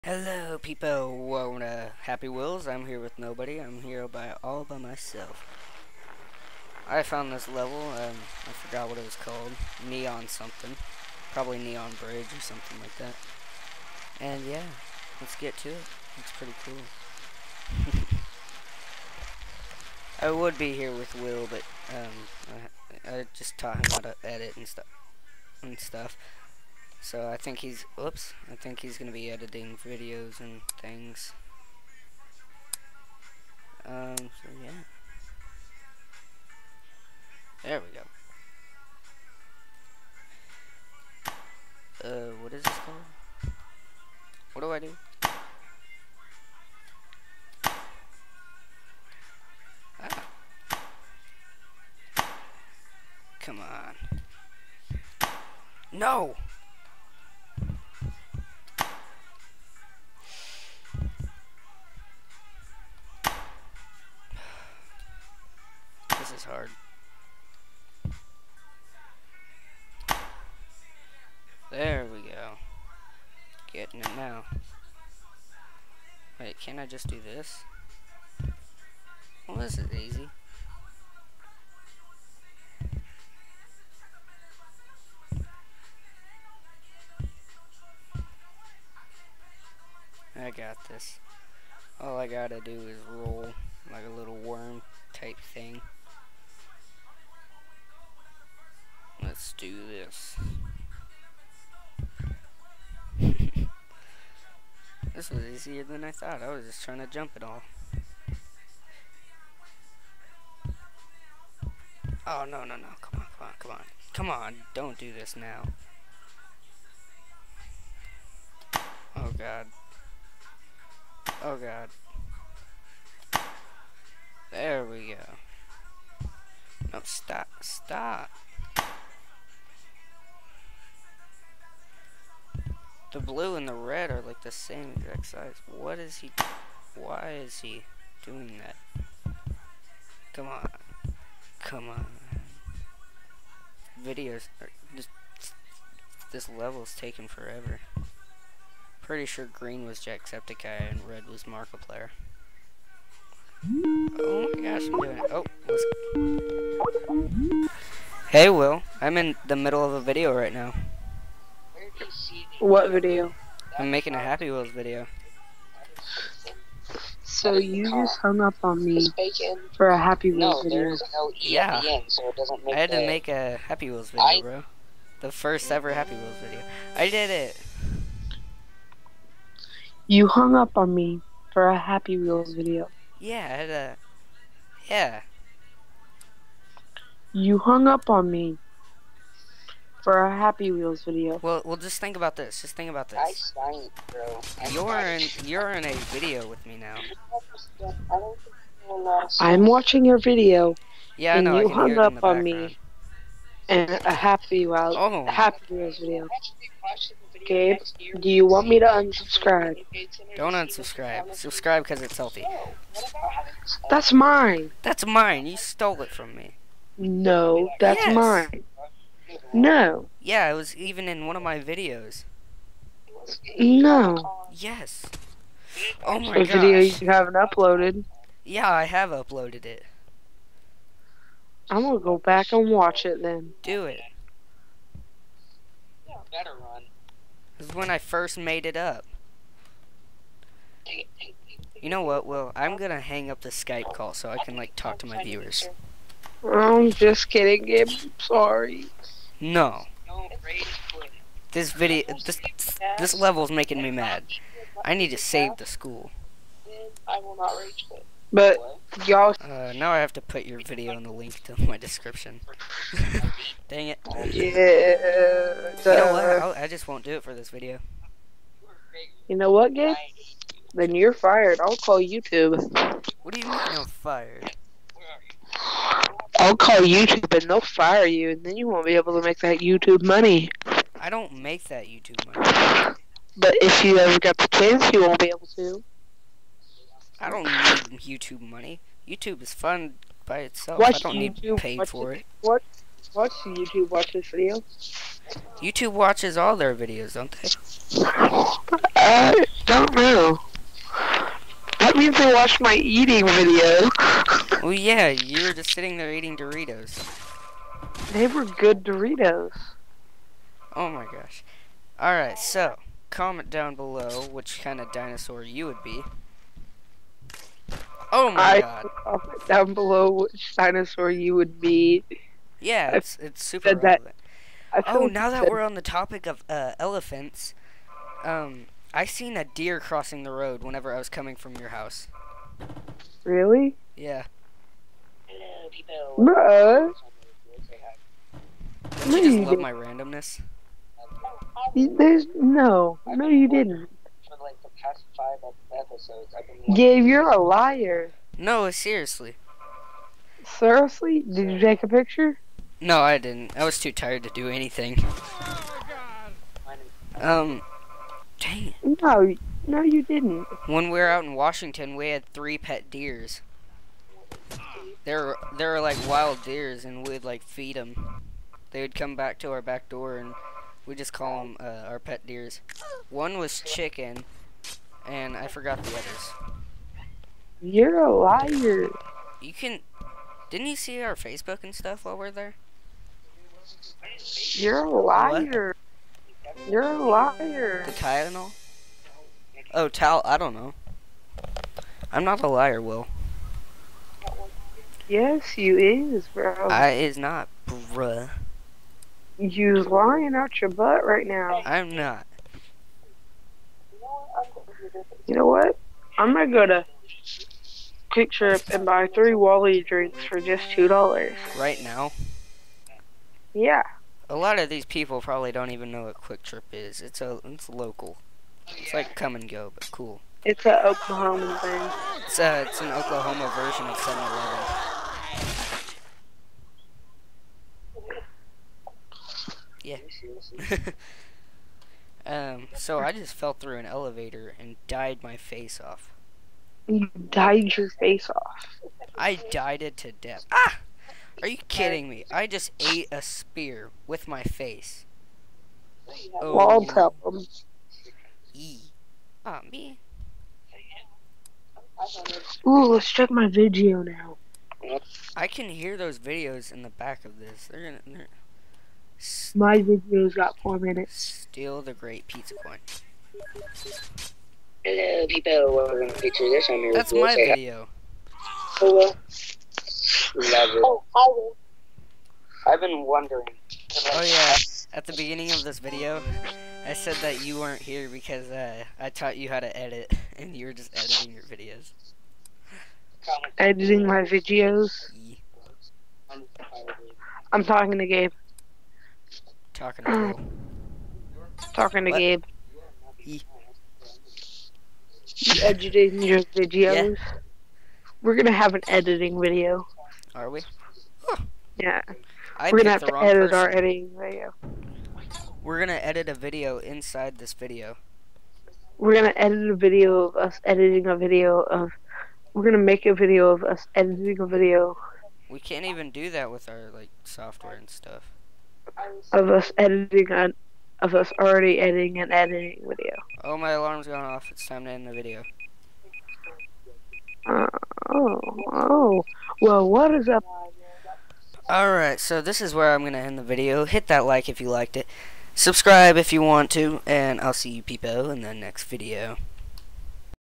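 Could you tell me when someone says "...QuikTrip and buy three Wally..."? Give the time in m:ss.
6:48.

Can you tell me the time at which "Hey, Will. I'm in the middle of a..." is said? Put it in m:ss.
2:38.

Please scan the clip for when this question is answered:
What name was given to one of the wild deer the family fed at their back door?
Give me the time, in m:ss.
6:13.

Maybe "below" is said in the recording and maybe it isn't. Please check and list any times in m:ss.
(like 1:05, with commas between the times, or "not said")
5:13, 5:19.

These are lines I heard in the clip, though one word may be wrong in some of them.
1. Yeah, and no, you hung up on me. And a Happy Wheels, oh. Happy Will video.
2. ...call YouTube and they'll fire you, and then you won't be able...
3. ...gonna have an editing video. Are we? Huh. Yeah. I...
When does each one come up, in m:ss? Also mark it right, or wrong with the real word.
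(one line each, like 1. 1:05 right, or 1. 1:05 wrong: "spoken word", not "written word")
1. 3:21 wrong: "Wheels", not "Will"
2. 4:36 right
3. 8:18 right.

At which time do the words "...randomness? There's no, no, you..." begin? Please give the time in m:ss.
5:39.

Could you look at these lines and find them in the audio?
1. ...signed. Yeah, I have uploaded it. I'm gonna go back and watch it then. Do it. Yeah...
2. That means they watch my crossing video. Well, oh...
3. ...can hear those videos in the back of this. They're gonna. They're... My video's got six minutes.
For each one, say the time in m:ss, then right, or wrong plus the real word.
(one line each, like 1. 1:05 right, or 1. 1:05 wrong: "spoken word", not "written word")
1. 3:47 wrong: "uploaded", not "signed"
2. 5:01 wrong: "eating", not "crossing"
3. 7:35 wrong: "four", not "six".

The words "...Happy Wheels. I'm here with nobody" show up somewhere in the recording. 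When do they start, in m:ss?
0:02.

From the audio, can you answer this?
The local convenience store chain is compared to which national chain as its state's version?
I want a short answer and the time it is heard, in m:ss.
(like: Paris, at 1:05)
7-Eleven, at 7:03.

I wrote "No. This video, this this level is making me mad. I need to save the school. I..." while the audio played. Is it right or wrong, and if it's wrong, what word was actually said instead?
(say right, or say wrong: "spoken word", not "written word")
right.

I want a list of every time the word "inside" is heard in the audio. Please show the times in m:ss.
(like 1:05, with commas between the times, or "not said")
8:26.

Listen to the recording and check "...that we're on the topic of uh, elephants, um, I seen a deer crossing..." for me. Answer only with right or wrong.
right.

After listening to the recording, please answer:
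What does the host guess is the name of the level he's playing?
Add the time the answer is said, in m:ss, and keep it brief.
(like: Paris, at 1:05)
Neon Bridge, at 0:11.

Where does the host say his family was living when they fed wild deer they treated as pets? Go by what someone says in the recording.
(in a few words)
Washington.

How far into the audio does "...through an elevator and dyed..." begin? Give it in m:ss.
7:13.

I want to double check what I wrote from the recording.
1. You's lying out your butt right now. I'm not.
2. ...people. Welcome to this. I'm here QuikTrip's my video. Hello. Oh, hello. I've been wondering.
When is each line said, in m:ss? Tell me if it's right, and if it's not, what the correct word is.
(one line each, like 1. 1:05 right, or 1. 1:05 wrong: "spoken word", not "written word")
1. 6:39 right
2. 7:45 wrong: "That", not "QuikTrip".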